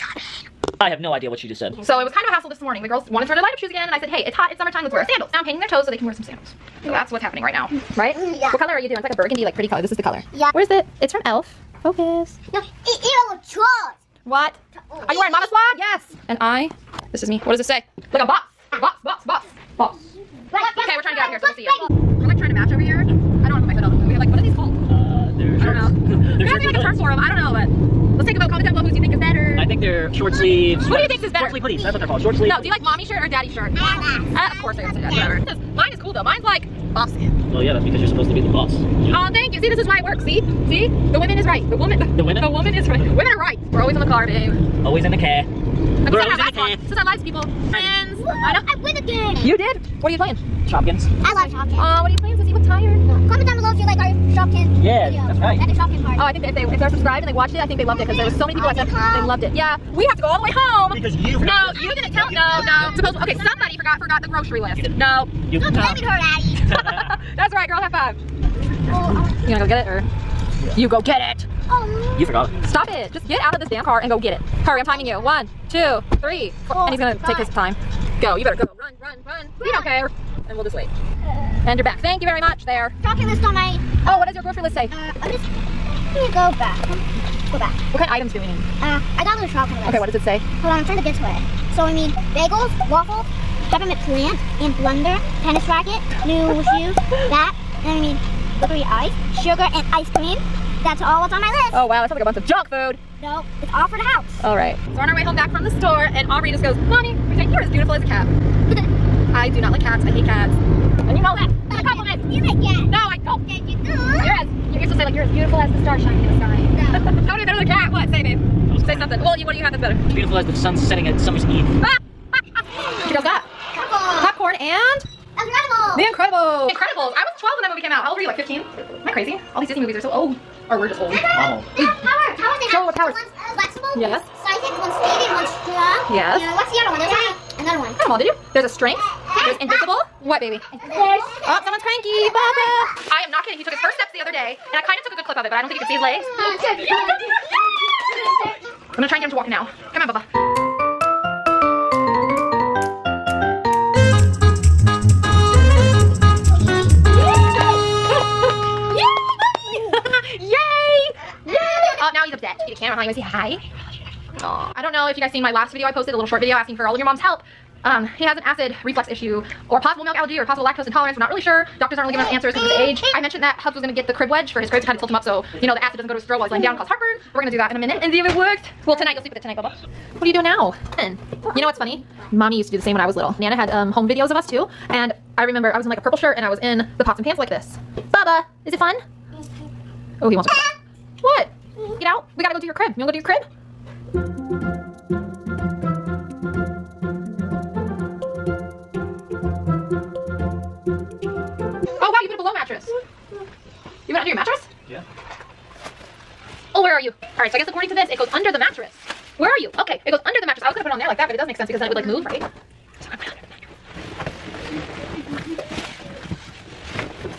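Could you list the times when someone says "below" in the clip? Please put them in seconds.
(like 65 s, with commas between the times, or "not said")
28 s, 53 s.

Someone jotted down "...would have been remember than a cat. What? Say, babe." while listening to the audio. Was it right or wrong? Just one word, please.
wrong.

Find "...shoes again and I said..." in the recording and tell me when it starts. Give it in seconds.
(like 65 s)
3 s.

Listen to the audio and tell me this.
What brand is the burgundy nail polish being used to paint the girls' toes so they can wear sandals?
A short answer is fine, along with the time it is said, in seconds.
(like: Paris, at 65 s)
e.l.f., at 11 s.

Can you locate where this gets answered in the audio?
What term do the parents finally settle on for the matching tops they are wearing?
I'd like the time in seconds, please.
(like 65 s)
31 s.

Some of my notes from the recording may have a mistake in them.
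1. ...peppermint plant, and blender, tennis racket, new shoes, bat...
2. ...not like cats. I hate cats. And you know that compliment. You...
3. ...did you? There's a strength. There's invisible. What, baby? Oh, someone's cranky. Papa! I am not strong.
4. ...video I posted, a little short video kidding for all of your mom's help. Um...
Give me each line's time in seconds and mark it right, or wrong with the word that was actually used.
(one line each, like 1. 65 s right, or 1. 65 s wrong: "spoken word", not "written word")
1. 93 s right
2. 109 s right
3. 138 s wrong: "kidding", not "strong"
4. 165 s wrong: "asking", not "kidding".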